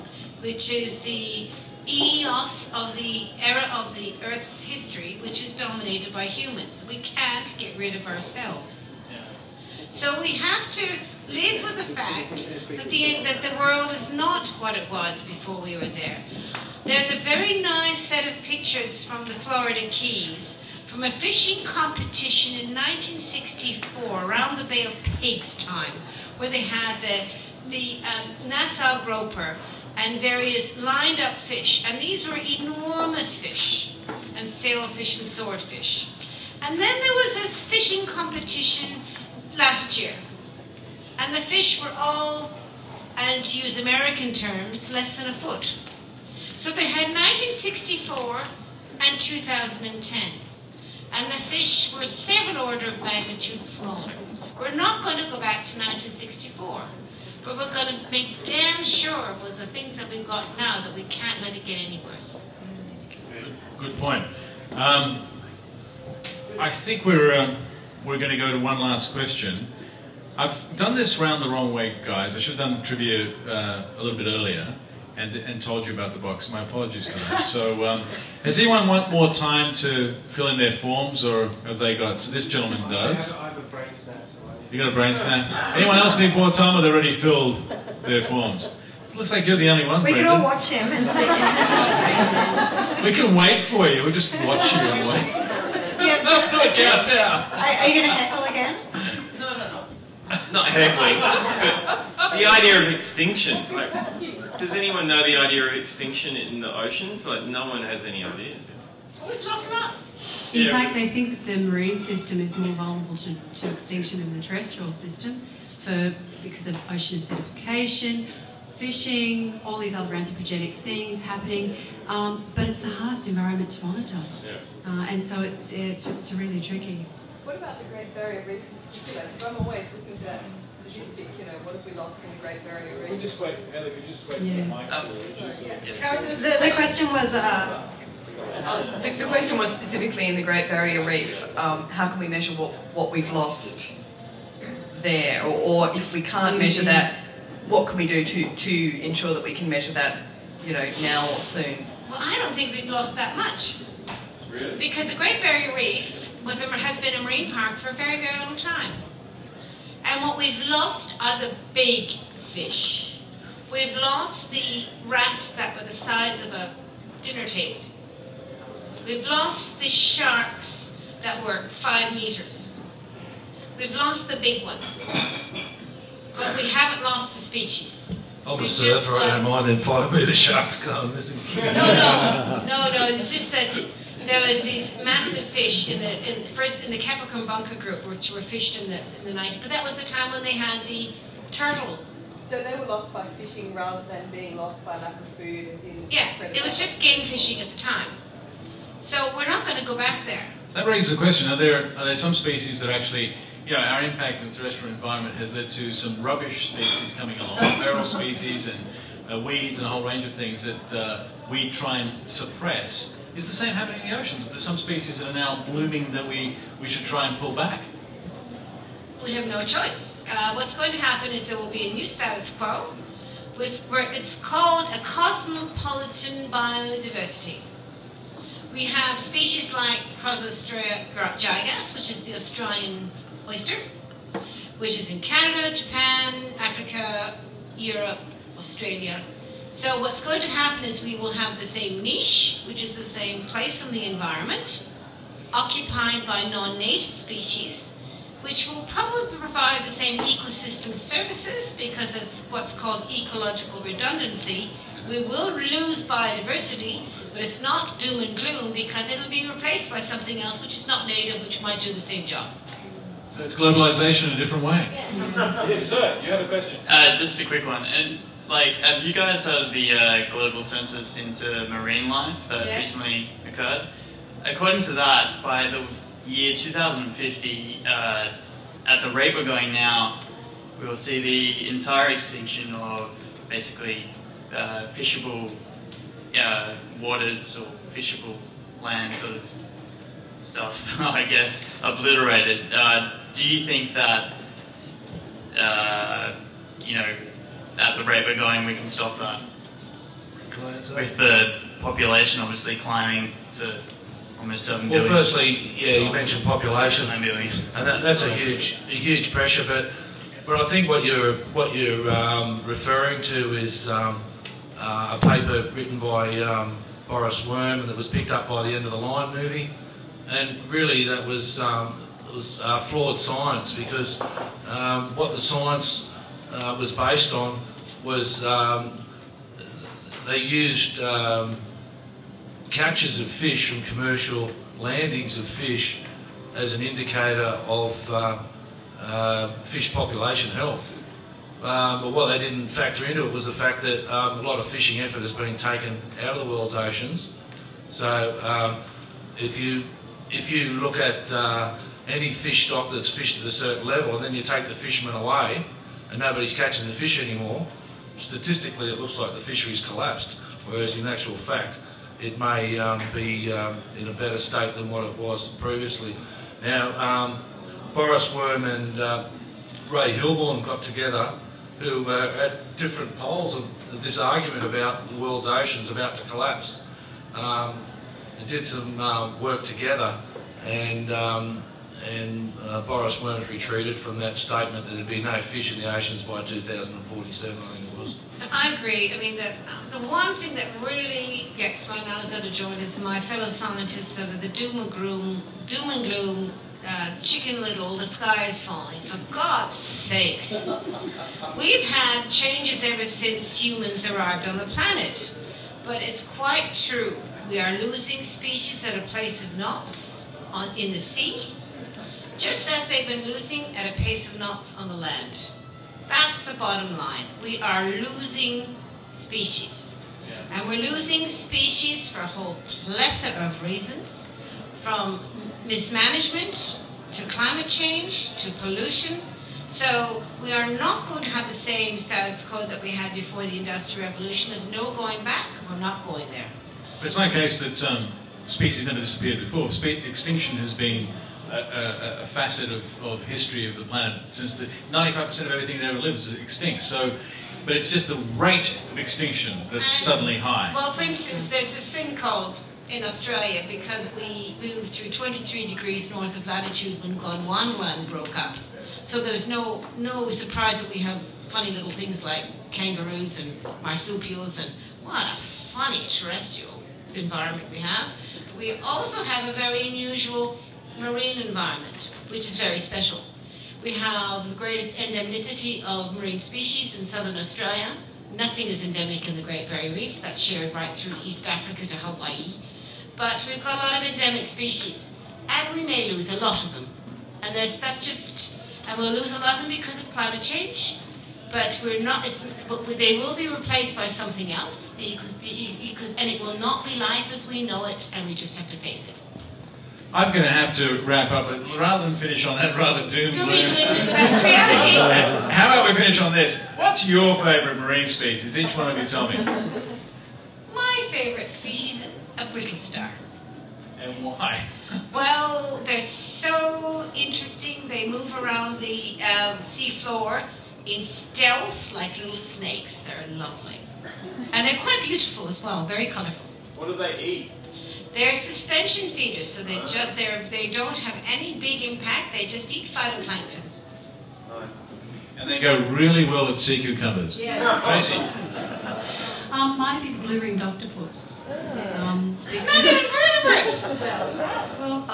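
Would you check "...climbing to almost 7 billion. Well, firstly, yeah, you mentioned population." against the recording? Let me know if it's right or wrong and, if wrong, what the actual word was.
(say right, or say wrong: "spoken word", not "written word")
right.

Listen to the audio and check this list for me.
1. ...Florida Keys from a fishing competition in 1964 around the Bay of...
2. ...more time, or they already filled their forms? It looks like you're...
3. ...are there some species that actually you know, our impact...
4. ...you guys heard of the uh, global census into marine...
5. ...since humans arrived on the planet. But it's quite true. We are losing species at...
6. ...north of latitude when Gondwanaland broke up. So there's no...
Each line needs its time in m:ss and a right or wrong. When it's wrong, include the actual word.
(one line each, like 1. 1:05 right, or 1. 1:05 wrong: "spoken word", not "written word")
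1. 0:19 right
2. 1:26 right
3. 3:21 right
4. 4:29 right
5. 6:43 right
6. 7:36 right.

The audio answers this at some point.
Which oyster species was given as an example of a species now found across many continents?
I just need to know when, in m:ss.
3:50.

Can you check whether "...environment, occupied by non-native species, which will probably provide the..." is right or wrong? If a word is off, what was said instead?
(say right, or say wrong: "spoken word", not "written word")
right.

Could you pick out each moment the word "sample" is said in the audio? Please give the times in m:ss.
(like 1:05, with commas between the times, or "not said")
not said.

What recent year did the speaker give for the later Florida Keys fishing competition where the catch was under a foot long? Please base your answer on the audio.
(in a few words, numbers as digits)
2010.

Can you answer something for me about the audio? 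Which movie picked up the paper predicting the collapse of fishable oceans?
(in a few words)
End of the Line.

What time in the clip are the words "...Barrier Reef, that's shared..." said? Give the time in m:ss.
7:59.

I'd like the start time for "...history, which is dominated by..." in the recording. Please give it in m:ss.
0:04.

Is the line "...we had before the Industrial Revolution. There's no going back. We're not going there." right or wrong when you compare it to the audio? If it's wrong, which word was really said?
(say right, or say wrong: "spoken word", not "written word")
right.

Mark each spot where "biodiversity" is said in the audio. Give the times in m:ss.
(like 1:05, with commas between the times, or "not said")
3:46, 4:16.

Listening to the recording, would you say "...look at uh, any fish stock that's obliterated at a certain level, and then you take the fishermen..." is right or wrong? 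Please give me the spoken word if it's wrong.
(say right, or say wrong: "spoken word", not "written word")
wrong: "fished", not "obliterated".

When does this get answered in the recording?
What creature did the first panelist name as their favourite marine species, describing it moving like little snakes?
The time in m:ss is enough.
8:32.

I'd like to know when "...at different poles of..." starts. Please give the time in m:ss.
6:12.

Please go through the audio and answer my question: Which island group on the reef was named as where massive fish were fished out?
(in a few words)
Capricorn Bunker group.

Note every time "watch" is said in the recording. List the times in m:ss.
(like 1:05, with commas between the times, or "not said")
1:30, 1:34.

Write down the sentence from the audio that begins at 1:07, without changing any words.
Um, we're going to go to one last question.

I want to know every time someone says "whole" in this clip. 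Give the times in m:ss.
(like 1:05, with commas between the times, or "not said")
3:29, 7:02.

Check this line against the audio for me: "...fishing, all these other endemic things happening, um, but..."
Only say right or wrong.
wrong.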